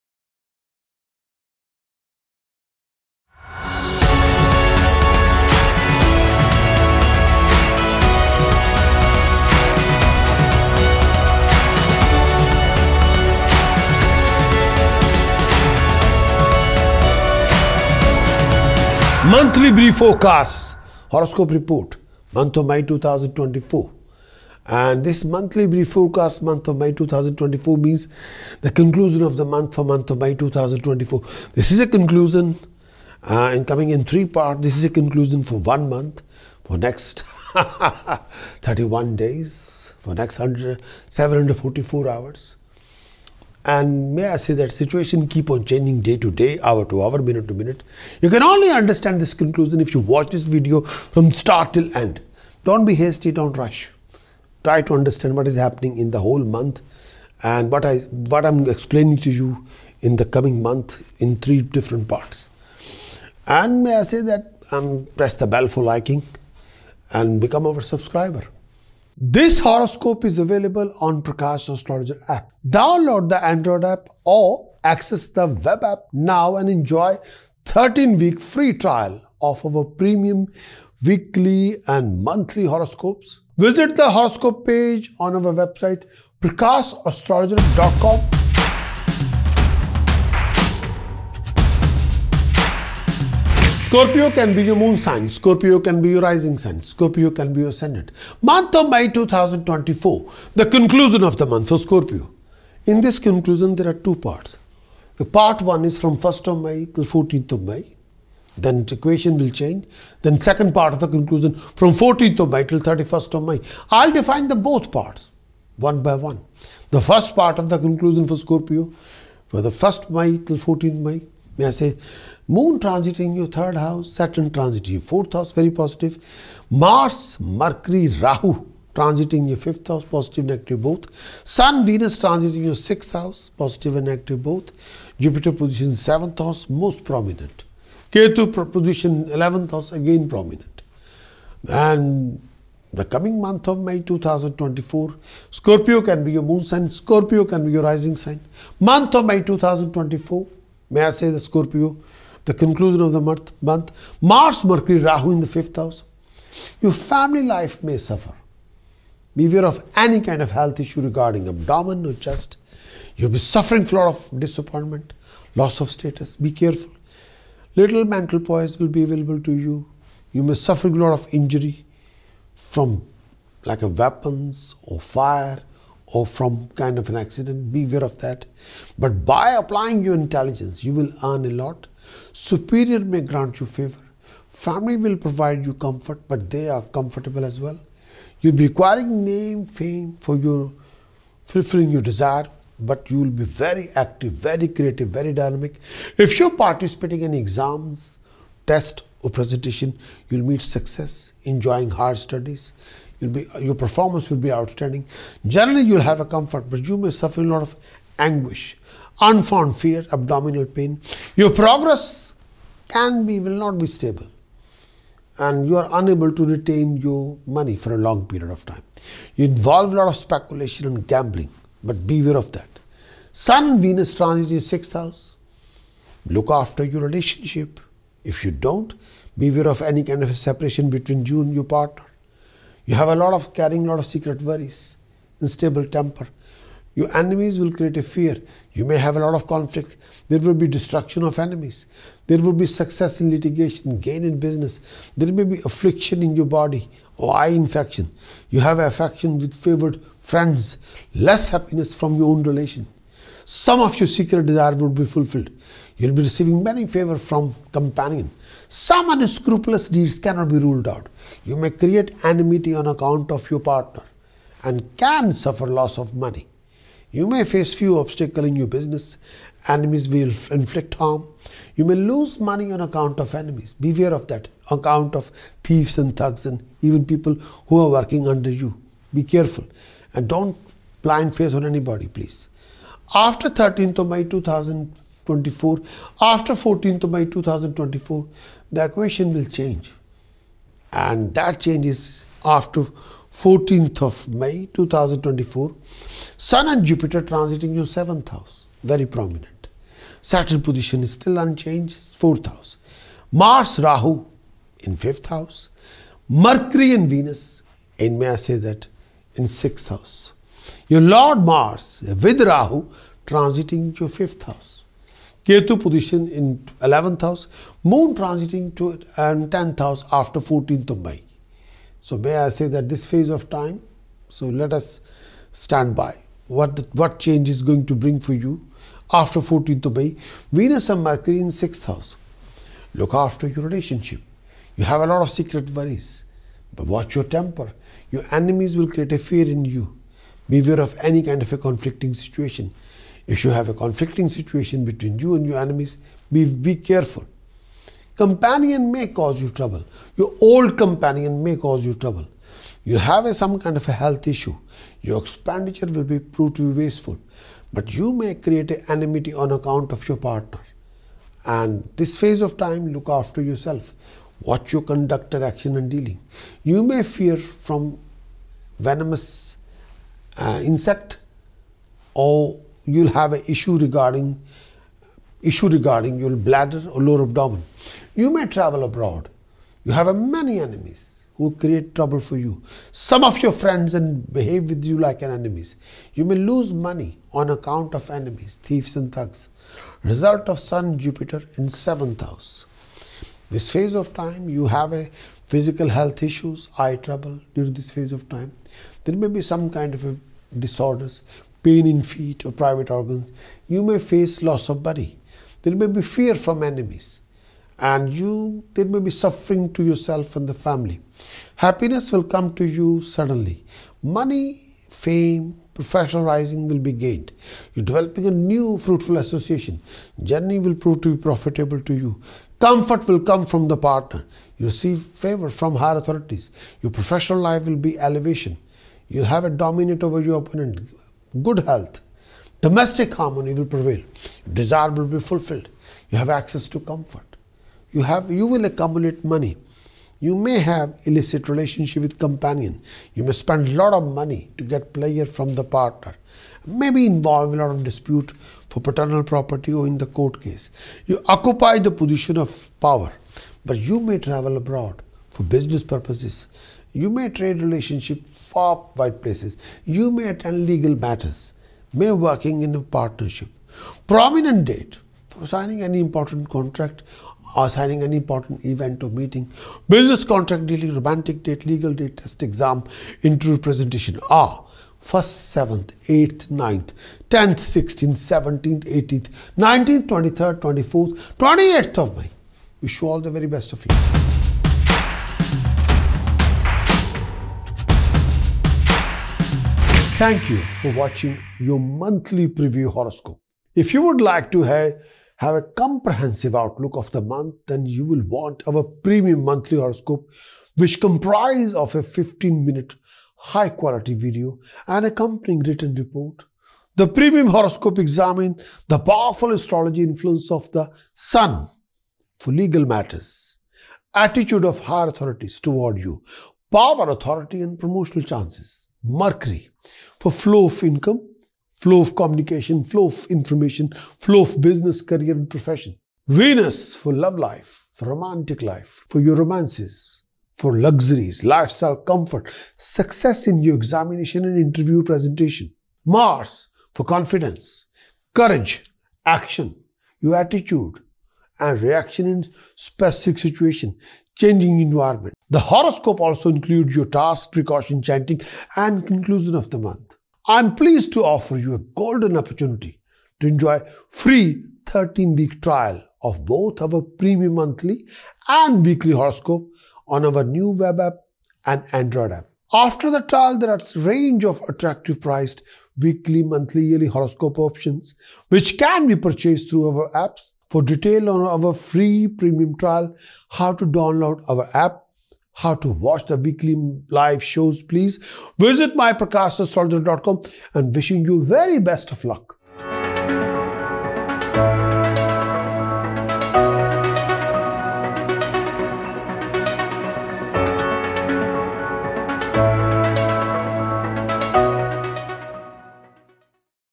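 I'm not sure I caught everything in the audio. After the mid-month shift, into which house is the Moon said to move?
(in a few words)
10th house.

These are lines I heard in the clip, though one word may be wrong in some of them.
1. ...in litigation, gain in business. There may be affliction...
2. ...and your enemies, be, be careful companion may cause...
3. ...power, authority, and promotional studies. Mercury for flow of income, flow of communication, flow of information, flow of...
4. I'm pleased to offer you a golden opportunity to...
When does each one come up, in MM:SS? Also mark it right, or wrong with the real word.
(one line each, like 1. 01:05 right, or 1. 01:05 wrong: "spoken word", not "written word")
1. 04:03 right
2. 05:45 right
3. 08:36 wrong: "chances", not "studies"
4. 09:10 right.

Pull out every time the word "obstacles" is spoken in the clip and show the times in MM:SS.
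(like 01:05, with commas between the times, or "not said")
04:27.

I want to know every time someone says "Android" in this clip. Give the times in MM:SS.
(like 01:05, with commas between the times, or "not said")
01:13, 09:21.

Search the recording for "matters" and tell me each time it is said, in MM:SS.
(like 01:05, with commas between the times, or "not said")
07:40, 08:32.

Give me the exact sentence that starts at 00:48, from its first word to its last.
You can only understand this conclusion if you watch this video from start till end.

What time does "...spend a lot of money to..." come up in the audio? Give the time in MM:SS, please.
07:23.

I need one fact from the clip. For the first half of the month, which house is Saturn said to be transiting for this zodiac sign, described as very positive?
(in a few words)
Fourth house.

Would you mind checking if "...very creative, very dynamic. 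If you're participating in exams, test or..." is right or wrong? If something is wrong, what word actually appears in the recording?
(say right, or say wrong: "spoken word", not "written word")
right.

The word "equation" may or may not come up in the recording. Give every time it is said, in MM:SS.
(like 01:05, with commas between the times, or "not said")
01:48, 04:48.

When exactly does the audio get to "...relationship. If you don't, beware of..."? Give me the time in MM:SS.
03:47.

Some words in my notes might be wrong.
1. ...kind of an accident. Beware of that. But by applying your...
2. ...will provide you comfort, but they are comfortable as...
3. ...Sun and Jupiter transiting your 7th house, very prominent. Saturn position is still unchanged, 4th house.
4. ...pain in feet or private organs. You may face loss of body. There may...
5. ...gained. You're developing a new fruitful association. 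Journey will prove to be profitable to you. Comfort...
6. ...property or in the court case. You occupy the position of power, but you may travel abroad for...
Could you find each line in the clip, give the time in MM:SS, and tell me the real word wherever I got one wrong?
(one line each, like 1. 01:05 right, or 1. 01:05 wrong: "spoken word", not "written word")
1. 02:56 right
2. 03:04 right
3. 04:55 right
4. 06:41 right
5. 06:56 right
6. 07:29 right.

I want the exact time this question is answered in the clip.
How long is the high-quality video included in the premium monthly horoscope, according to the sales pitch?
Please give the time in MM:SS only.
08:22.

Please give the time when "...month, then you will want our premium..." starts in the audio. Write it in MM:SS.
08:17.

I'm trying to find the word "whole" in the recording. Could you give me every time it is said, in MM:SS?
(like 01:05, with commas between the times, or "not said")
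00:56.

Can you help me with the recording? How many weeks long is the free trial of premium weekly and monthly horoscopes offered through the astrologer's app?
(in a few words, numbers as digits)
13.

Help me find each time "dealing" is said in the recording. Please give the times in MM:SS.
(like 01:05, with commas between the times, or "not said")
06:05, 07:50.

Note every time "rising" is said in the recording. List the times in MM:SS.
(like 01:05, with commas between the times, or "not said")
01:36, 02:27, 06:56.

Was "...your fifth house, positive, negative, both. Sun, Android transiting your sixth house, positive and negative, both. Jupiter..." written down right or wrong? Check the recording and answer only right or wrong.
wrong.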